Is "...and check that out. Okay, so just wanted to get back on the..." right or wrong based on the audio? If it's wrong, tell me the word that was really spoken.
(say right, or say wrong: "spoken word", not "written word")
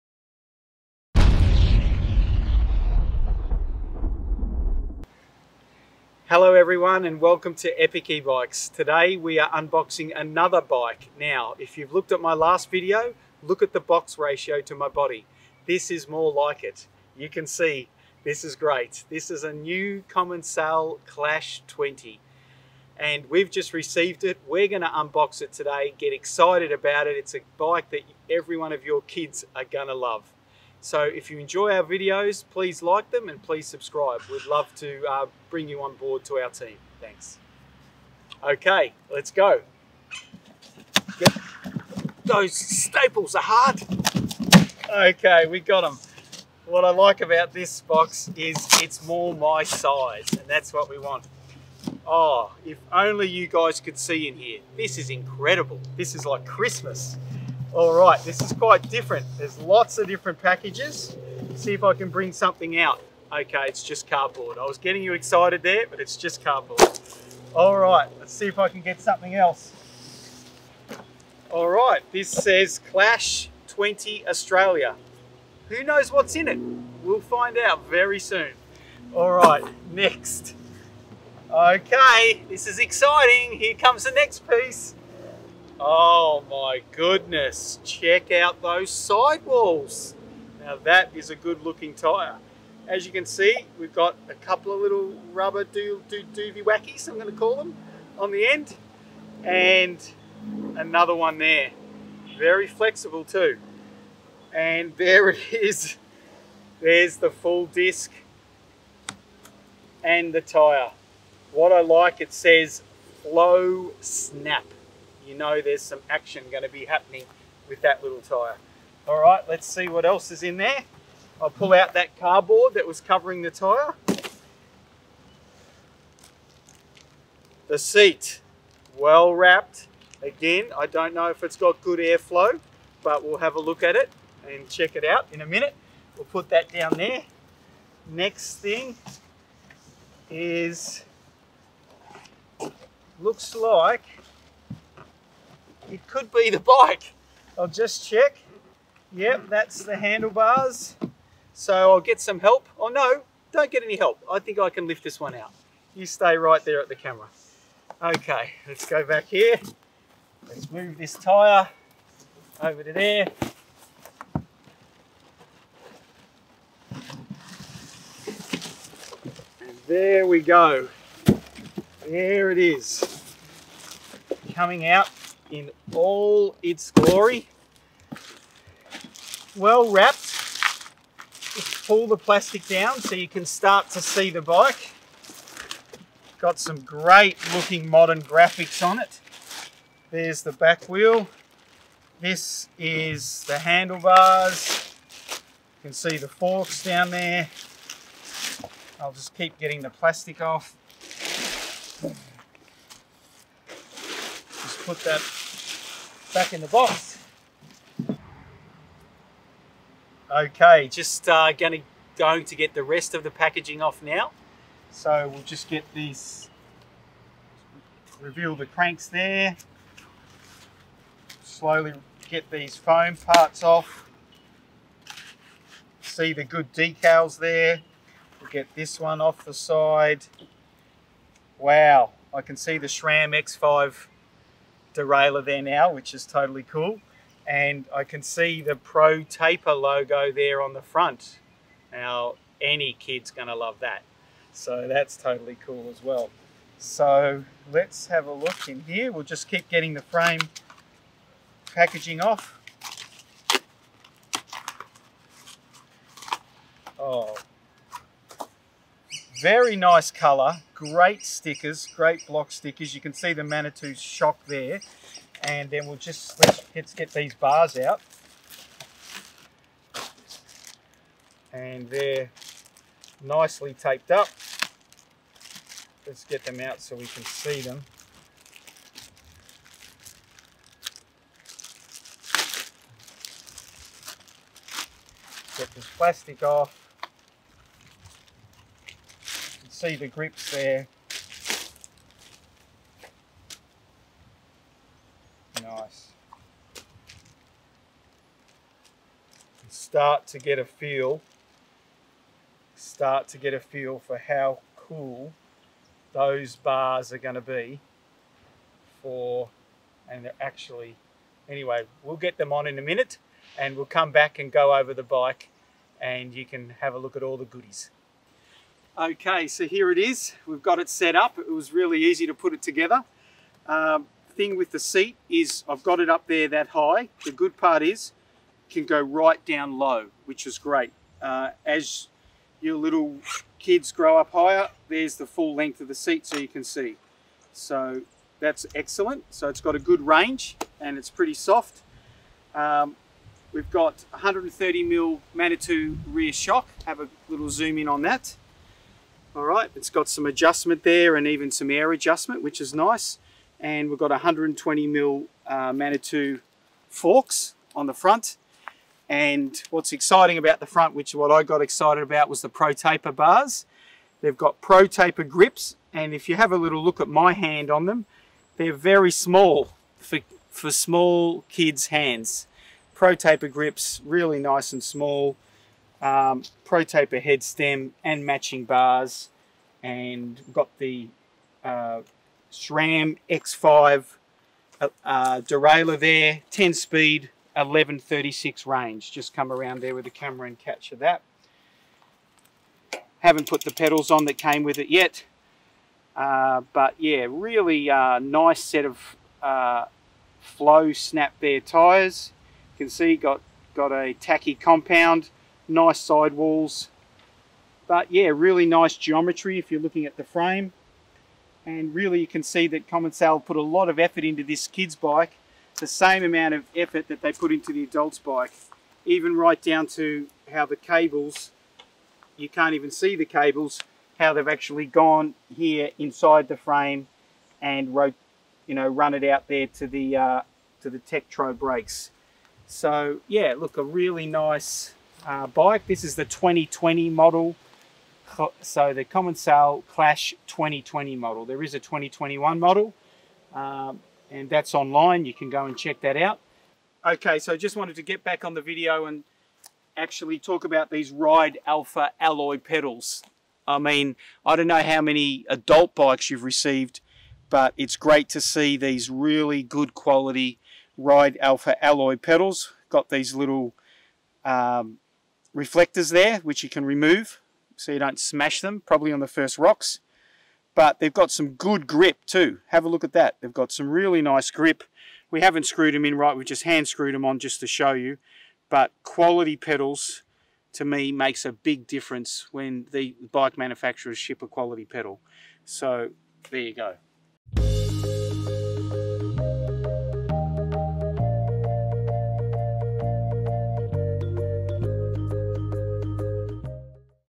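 right.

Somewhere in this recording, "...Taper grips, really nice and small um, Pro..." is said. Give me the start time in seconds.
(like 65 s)
373 s.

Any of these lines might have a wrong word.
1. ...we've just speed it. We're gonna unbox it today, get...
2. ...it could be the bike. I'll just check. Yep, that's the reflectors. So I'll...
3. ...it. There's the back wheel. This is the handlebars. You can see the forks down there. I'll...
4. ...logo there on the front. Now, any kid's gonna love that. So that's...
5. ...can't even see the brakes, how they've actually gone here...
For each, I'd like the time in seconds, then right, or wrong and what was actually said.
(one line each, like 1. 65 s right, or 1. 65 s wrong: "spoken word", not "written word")
1. 23 s wrong: "received", not "speed"
2. 145 s wrong: "handlebars", not "reflectors"
3. 188 s right
4. 239 s right
5. 422 s wrong: "cables", not "brakes".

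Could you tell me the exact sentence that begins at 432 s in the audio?
So yeah, look, a really nice uh, bike.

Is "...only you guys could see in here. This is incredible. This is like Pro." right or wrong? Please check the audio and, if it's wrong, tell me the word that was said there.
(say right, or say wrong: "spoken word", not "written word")
wrong: "Christmas", not "Pro".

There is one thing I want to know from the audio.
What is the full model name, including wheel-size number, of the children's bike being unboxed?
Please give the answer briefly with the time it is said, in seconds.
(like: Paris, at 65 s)
Commencal Clash 20, at 20 s.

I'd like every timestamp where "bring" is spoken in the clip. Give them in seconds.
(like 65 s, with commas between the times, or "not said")
35 s, 62 s.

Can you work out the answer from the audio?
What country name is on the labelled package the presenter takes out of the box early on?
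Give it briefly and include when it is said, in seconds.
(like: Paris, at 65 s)
Australia, at 74 s.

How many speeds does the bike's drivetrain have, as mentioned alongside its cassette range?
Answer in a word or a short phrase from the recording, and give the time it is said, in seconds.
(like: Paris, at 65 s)
10, at 386 s.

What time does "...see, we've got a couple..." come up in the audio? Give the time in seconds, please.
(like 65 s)
93 s.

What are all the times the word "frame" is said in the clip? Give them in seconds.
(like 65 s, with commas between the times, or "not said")
250 s, 410 s, 426 s.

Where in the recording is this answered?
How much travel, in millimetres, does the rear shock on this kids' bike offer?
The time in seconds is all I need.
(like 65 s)
344 s.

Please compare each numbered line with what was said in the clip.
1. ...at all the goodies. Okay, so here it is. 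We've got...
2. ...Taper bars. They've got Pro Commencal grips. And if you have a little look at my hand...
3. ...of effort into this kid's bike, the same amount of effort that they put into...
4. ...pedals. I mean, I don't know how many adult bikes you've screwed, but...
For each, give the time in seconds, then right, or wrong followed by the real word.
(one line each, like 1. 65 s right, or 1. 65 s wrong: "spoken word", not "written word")
1. 317 s right
2. 362 s wrong: "Taper", not "Commencal"
3. 413 s right
4. 452 s wrong: "received", not "screwed".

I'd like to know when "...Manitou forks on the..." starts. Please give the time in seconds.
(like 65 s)
355 s.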